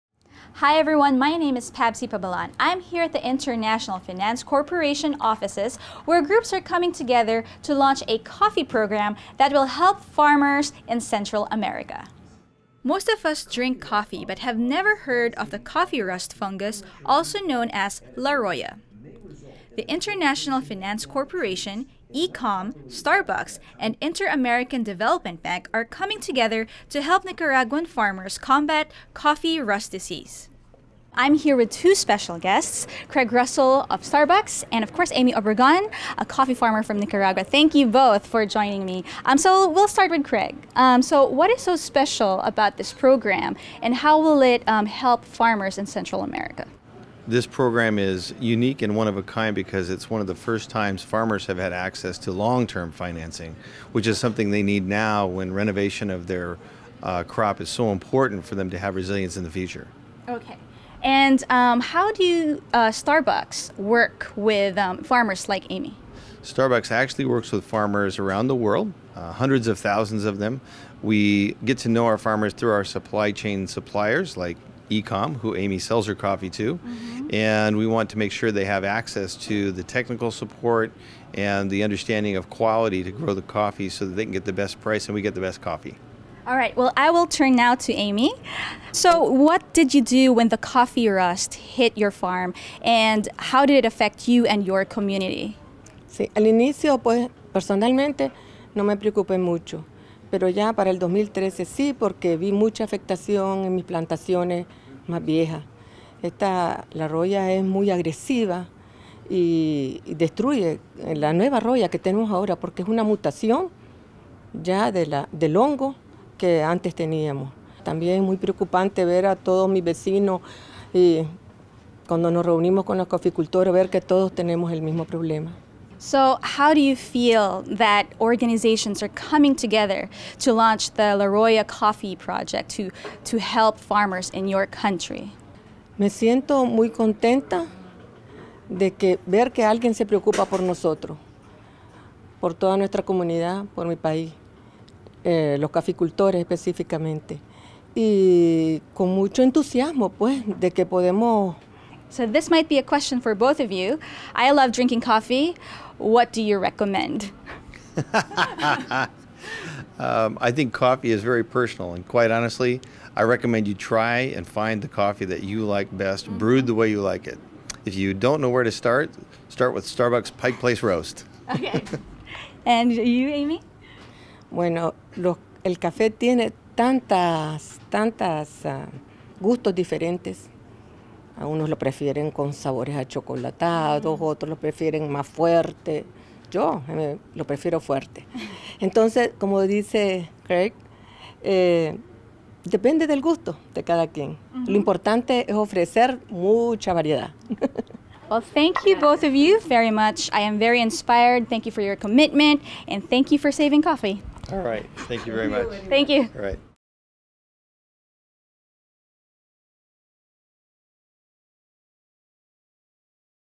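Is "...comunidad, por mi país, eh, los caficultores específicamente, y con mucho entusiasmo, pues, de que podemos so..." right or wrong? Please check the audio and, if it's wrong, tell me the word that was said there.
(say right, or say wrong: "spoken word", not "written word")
right.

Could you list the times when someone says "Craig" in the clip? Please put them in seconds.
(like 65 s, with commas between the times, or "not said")
33 s, 40 s, 190 s.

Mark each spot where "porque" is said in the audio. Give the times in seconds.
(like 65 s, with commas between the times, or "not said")
101 s, 112 s.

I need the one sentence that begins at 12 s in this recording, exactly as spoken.
Most of us drink coffee but have never heard of the coffee rust fungus, also known as La Roya.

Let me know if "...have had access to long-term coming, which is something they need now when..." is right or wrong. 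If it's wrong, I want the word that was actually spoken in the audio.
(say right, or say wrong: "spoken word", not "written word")
wrong: "financing", not "coming".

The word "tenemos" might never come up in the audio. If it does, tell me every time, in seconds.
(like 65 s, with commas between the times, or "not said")
111 s, 124 s.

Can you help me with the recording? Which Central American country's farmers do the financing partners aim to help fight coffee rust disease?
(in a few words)
Nicaragua.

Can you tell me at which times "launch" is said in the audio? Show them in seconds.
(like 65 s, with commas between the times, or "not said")
7 s, 130 s.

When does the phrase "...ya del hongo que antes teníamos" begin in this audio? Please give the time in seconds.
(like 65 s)
114 s.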